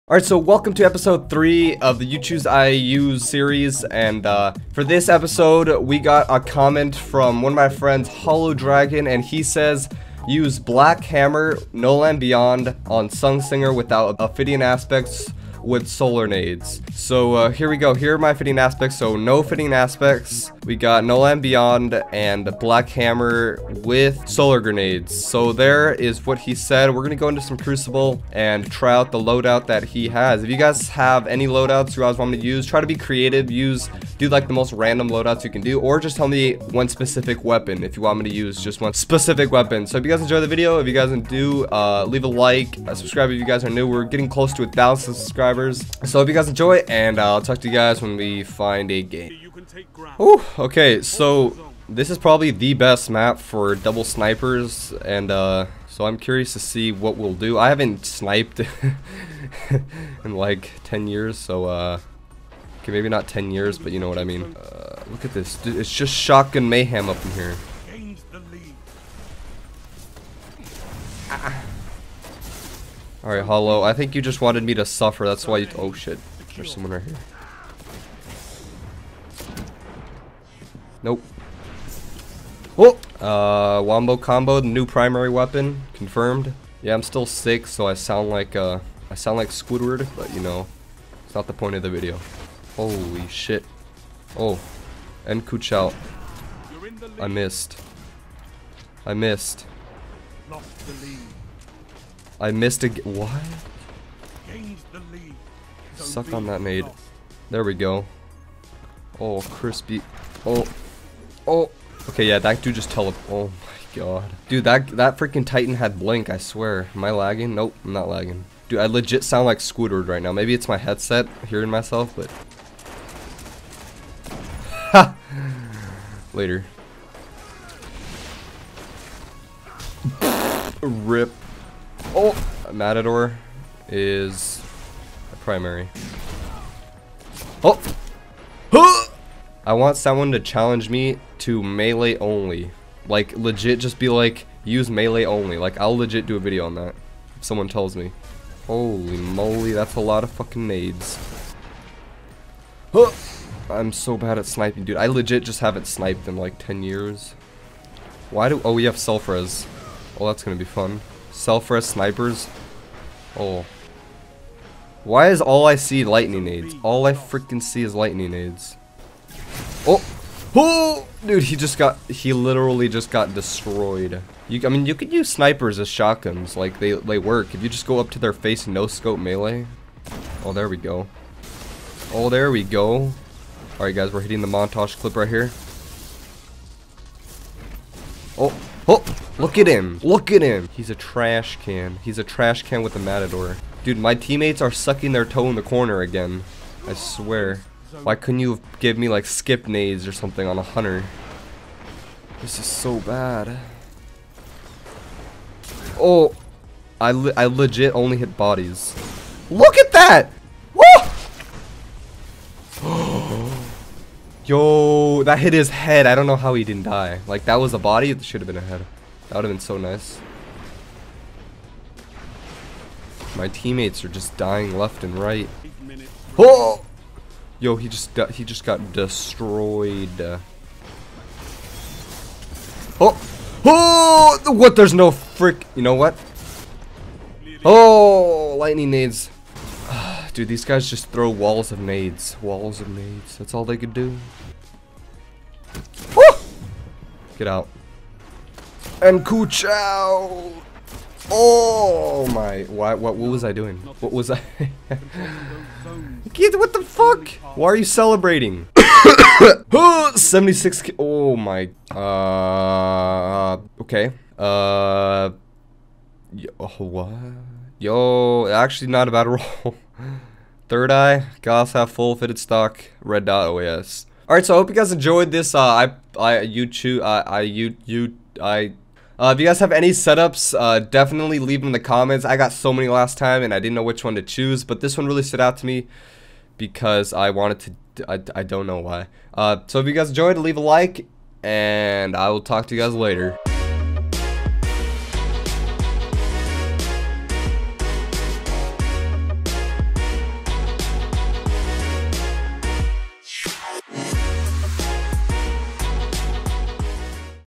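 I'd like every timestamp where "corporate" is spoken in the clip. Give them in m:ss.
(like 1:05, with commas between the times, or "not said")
not said.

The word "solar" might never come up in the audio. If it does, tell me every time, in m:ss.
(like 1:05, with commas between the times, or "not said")
0:15, 0:24.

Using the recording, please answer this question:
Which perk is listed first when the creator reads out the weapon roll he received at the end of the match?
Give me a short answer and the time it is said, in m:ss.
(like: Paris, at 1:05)
Third Eye, at 4:30.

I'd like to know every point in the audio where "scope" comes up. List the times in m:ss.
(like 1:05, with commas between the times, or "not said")
2:58.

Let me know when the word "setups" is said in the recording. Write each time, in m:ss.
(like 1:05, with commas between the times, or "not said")
4:39.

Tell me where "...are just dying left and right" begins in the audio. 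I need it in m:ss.
3:44.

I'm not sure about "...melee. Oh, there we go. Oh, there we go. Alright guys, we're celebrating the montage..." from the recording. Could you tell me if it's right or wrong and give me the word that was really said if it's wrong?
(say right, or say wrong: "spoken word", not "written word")
wrong: "hitting", not "celebrating".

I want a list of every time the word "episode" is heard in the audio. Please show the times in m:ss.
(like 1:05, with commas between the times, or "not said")
0:00, 0:05.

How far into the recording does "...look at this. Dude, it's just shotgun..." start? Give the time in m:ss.
1:05.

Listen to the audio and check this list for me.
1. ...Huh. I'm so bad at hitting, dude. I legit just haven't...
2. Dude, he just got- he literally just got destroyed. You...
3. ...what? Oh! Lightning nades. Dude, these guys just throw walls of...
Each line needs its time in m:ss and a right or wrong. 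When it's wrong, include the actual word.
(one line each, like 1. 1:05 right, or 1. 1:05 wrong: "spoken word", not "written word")
1. 2:32 wrong: "sniping", not "hitting"
2. 2:51 right
3. 3:55 right.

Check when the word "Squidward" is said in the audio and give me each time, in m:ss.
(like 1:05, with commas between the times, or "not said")
1:29, 1:59.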